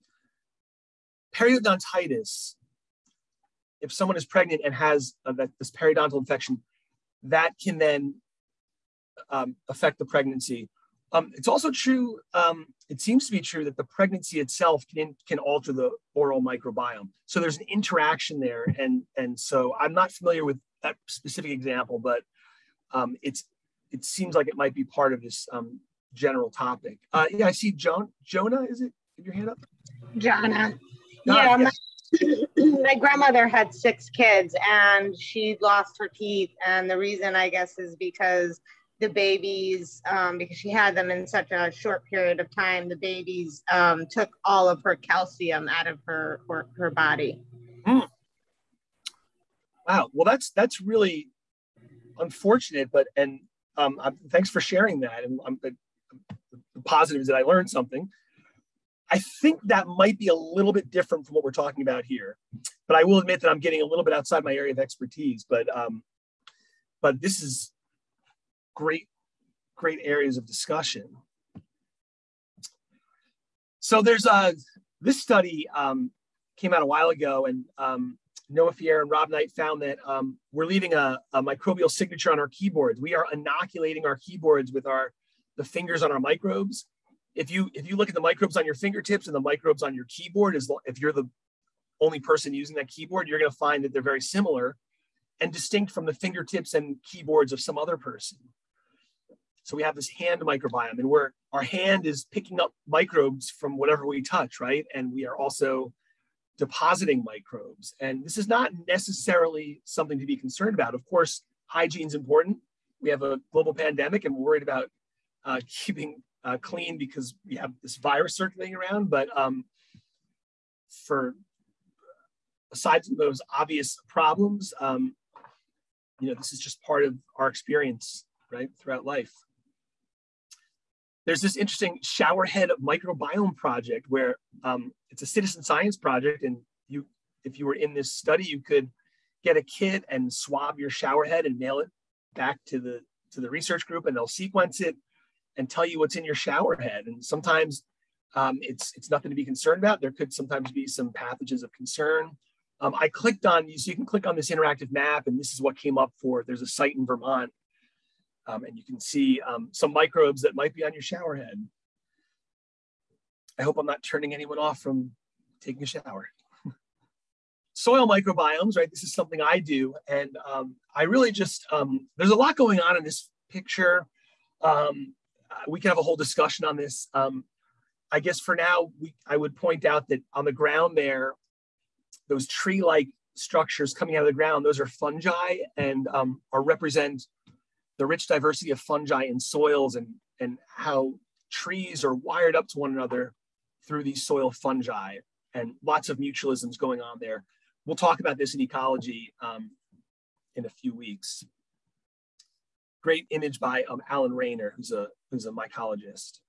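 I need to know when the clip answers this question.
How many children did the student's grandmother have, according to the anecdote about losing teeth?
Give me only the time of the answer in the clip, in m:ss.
0:33.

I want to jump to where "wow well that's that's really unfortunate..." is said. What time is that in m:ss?
0:49.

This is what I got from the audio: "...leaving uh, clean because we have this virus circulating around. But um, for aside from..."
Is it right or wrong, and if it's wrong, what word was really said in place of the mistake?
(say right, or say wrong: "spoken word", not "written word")
wrong: "keeping", not "leaving".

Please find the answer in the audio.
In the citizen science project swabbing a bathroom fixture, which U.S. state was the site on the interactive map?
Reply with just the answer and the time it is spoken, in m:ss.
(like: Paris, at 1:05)
Vermont, at 2:37.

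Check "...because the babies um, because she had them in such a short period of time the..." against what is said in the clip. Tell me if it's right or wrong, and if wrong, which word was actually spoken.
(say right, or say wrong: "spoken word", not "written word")
right.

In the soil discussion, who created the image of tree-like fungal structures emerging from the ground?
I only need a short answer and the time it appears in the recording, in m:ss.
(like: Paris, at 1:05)
Alan Rayner, at 3:24.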